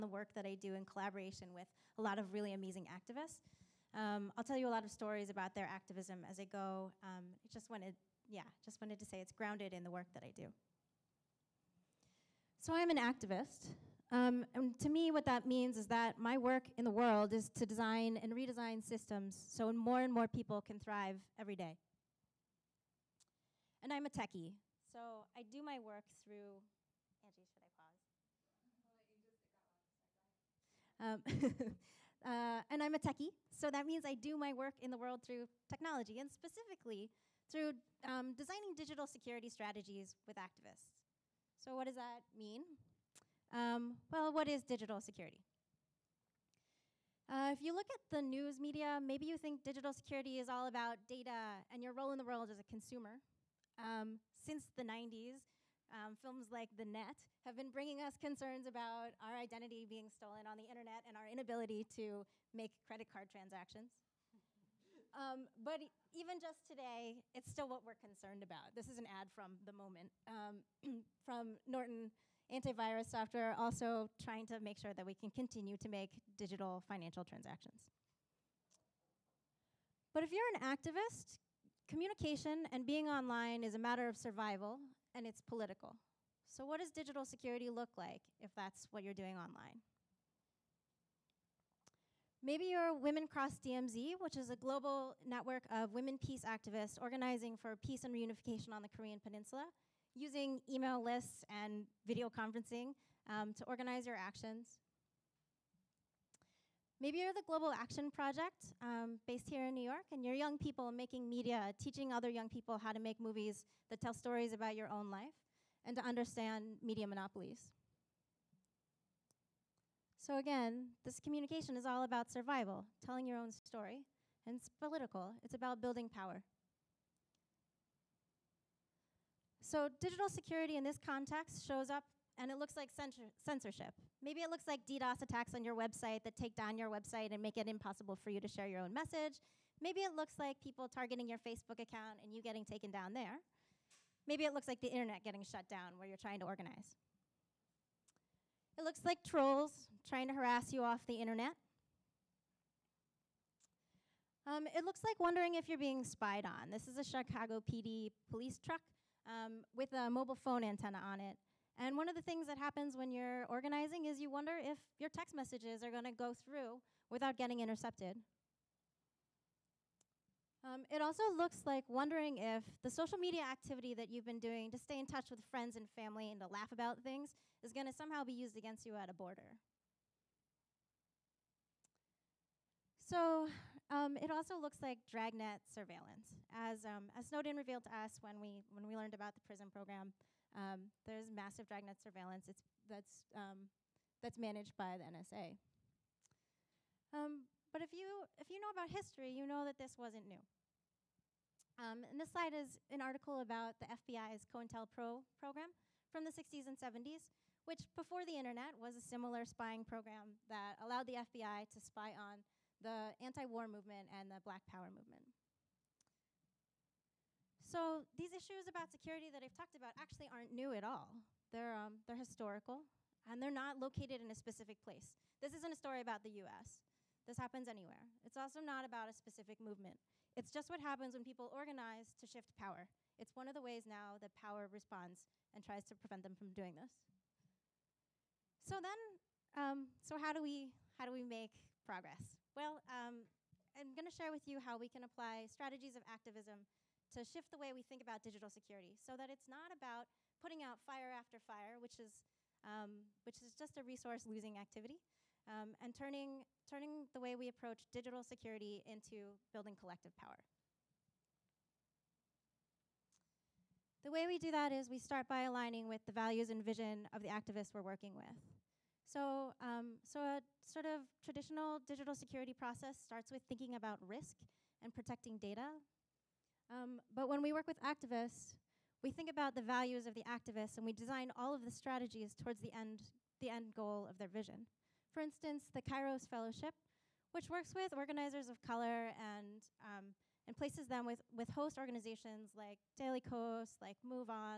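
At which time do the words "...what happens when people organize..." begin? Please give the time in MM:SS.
03:50.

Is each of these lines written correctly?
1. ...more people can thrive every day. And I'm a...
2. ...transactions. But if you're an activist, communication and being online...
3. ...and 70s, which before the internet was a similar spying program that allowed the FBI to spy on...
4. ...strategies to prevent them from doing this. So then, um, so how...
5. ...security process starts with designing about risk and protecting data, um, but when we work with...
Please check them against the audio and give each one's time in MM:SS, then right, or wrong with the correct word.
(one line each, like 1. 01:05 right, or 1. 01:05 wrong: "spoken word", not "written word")
1. 00:20 right
2. 01:17 right
3. 03:26 right
4. 03:55 wrong: "tries", not "strategies"
5. 04:32 wrong: "thinking", not "designing".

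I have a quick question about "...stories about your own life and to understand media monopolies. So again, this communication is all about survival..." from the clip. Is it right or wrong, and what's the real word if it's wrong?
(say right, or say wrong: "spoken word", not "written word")
right.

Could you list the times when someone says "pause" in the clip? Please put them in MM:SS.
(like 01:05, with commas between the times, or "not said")
00:27.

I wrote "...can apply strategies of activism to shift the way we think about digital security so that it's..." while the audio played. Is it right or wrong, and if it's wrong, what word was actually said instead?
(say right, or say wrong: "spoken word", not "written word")
right.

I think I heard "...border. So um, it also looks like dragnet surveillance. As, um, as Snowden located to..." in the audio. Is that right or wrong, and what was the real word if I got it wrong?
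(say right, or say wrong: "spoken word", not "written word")
wrong: "revealed", not "located".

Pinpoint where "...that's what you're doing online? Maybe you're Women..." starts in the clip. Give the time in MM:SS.
01:28.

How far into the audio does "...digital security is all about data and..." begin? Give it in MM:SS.
00:49.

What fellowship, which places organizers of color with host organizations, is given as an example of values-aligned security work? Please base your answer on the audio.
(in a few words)
Kairos Fellowship.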